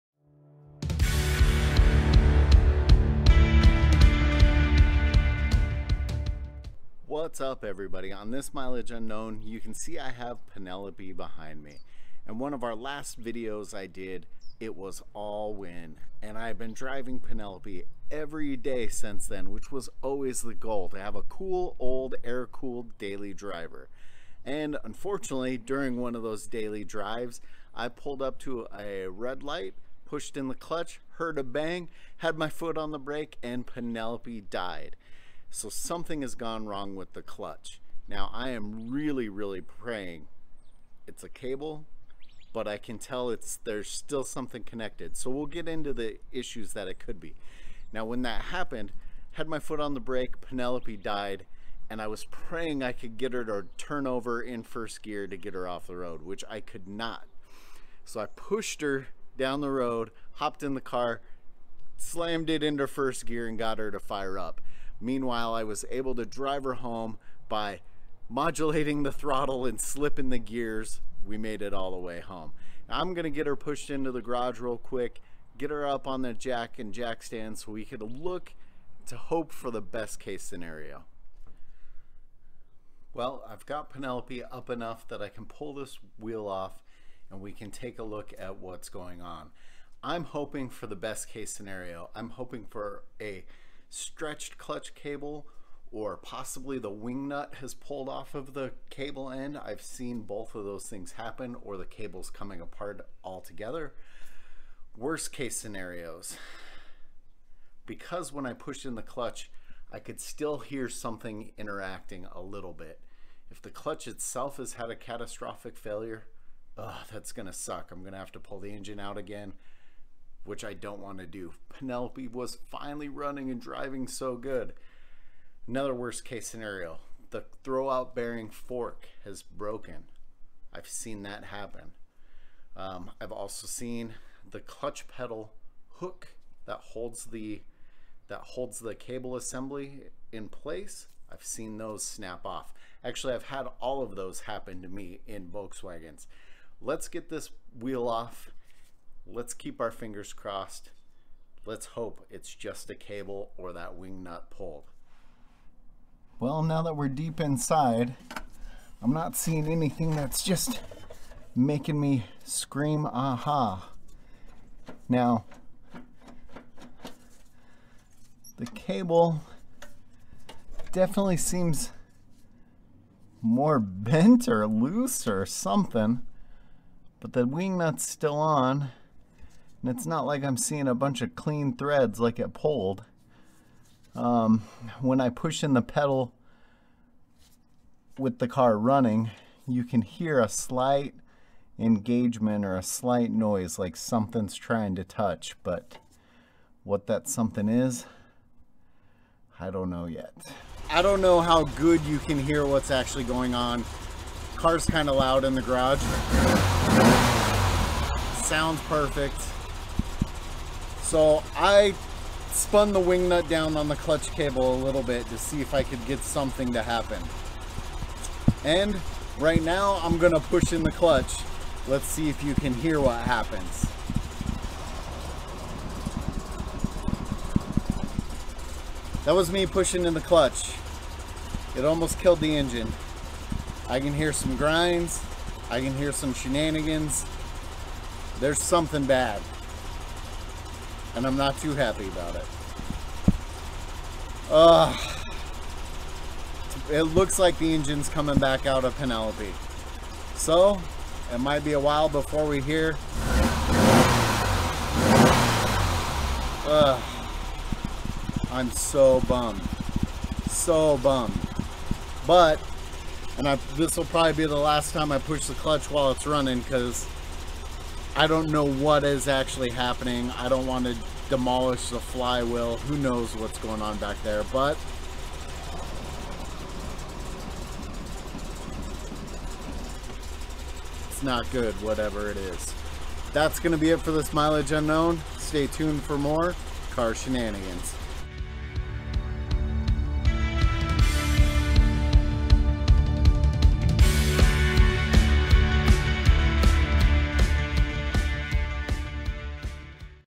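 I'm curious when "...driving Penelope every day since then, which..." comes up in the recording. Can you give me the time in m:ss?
0:16.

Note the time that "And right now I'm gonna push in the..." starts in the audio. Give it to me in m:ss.
3:38.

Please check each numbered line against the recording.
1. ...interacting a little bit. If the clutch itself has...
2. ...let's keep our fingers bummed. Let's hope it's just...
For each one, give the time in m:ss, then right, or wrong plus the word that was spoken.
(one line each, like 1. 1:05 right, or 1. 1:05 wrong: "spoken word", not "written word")
1. 1:51 right
2. 2:29 wrong: "crossed", not "bummed".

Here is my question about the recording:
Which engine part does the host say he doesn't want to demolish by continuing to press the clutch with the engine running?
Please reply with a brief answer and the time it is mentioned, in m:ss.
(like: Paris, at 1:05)
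flywheel, at 4:31.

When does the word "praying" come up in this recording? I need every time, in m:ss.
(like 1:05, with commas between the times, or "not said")
0:39, 0:52.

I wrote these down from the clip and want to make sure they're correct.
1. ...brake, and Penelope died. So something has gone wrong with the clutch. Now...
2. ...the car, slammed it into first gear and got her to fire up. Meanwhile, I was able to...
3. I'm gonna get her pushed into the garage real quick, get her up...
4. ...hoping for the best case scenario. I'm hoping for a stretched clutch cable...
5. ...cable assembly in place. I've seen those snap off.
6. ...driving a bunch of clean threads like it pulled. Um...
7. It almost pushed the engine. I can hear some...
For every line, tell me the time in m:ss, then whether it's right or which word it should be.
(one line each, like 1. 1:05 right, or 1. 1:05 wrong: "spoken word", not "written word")
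1. 0:32 right
2. 1:00 right
3. 1:12 right
4. 1:30 right
5. 2:18 right
6. 3:00 wrong: "seeing", not "driving"
7. 3:51 wrong: "killed", not "pushed".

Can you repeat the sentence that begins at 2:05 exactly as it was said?
Another worst case scenario the throwout bearing fork has broken.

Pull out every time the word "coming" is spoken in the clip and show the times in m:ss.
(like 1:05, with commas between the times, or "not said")
1:42, 4:08.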